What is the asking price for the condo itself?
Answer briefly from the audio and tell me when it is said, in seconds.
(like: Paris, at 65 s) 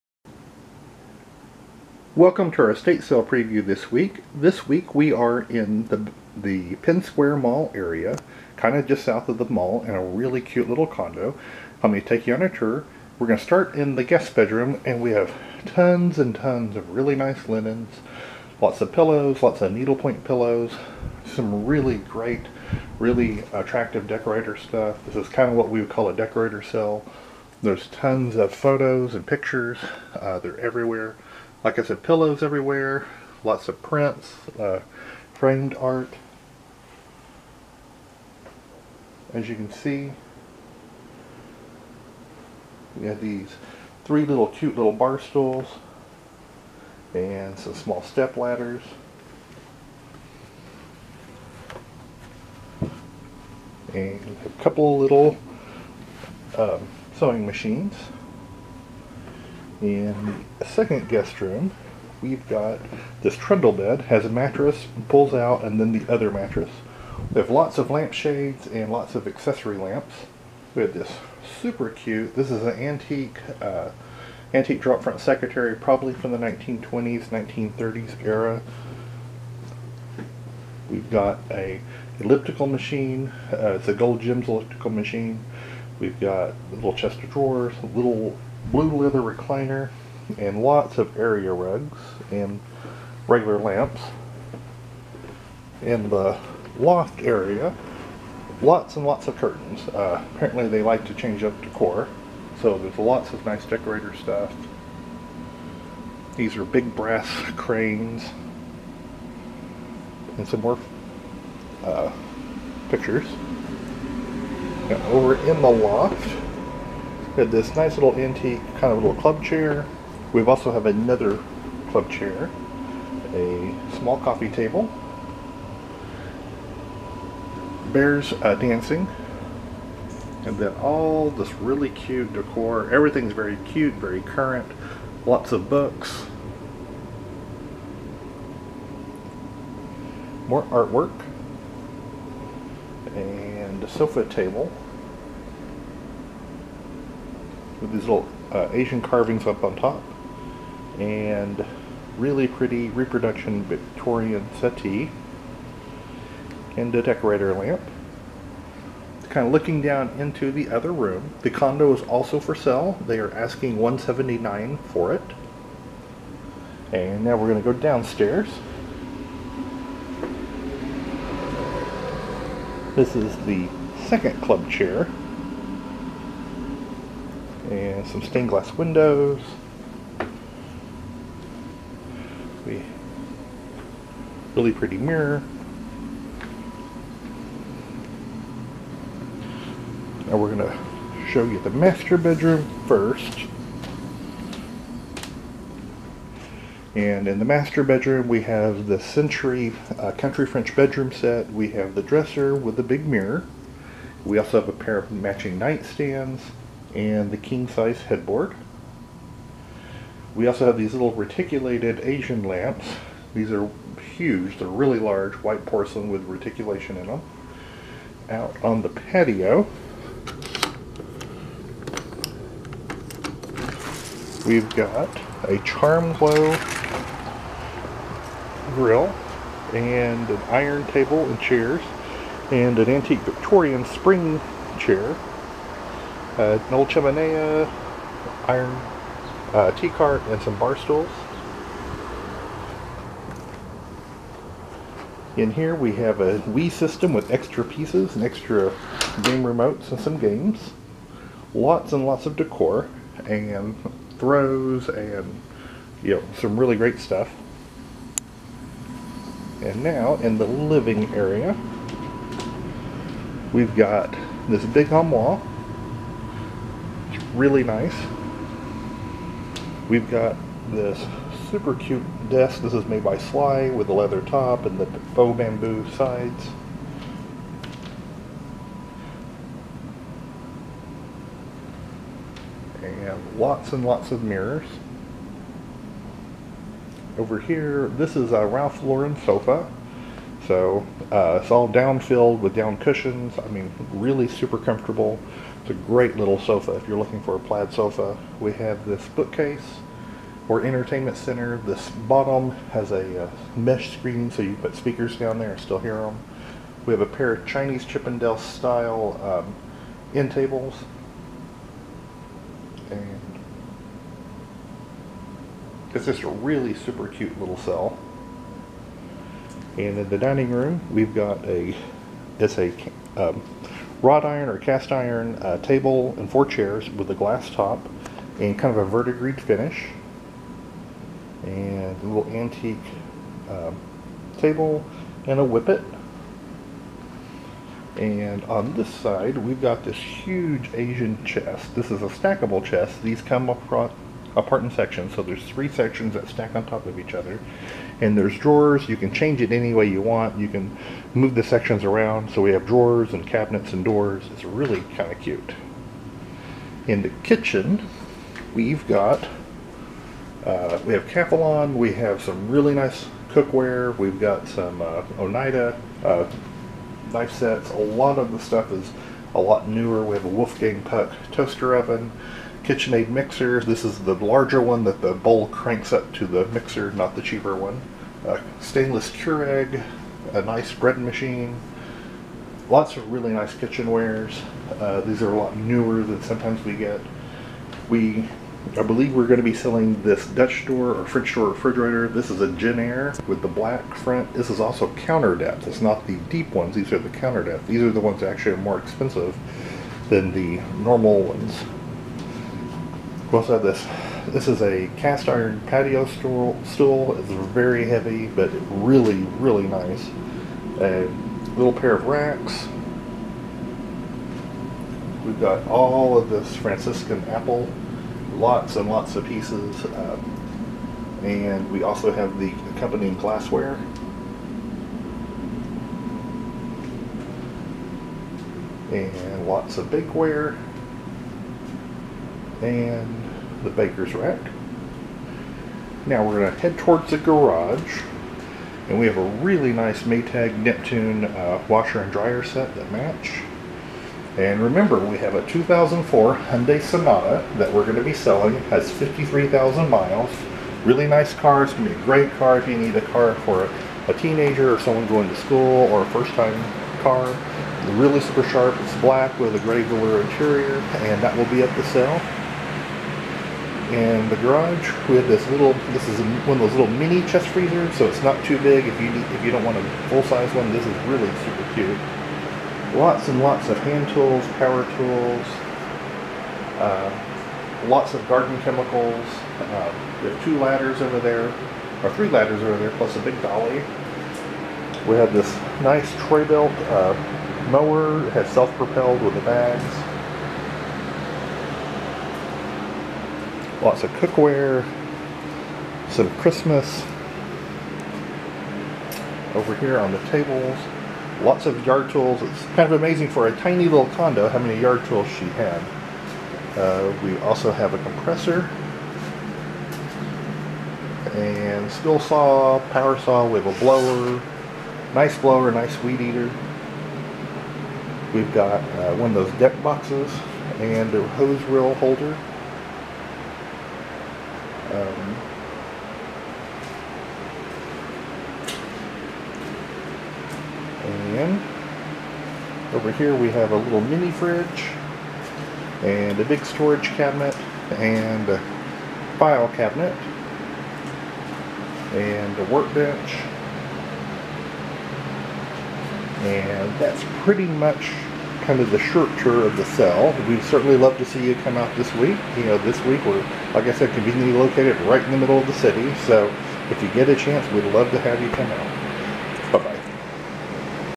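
179, at 163 s.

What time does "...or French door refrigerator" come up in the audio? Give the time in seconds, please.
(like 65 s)
390 s.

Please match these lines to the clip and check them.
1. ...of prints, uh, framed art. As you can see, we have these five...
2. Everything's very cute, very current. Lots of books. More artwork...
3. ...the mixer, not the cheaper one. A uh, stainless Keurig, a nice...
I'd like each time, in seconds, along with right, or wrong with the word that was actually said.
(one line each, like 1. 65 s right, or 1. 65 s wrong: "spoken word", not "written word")
1. 33 s wrong: "three", not "five"
2. 132 s right
3. 376 s right.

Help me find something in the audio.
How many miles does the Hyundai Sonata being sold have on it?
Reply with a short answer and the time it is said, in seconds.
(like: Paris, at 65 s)
53,000, at 448 s.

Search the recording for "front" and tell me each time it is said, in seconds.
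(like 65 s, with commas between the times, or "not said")
75 s, 393 s.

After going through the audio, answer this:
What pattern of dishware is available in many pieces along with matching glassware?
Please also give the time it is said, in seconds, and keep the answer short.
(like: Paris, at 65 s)
Franciscan apple, at 416 s.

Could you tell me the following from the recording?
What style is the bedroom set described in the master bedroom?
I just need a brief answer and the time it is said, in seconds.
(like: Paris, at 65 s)
Country French, at 200 s.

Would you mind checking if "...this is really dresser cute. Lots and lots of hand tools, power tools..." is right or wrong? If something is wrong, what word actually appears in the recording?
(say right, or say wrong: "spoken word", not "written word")
wrong: "super", not "dresser".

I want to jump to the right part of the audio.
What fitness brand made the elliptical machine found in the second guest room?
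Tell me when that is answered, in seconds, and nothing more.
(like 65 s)
83 s.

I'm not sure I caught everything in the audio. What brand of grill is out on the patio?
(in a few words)
Charm Glow.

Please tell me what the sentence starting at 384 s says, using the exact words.
Uh, these are a lot newer than sometimes we get.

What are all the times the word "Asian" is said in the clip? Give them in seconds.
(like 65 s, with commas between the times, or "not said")
148 s, 212 s, 340 s.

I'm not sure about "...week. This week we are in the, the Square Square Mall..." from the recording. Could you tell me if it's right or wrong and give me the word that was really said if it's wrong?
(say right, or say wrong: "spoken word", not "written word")
wrong: "Penn", not "Square".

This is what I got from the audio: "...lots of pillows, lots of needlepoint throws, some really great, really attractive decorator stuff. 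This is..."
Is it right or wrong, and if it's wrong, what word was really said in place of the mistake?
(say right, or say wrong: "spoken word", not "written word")
wrong: "pillows", not "throws".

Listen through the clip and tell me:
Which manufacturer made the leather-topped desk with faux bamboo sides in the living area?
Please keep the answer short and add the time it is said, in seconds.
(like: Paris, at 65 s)
Sligh, at 273 s.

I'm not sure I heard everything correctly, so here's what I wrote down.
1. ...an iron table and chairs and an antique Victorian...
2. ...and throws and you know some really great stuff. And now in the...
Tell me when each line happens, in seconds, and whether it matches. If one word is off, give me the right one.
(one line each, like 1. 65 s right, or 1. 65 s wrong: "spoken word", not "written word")
1. 230 s right
2. 253 s right.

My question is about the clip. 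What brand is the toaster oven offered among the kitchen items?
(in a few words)
Wolfgang Puck.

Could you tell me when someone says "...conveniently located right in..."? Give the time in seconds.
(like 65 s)
554 s.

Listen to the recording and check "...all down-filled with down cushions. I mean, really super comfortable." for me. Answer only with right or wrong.
right.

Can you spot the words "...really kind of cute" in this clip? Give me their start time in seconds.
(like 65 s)
354 s.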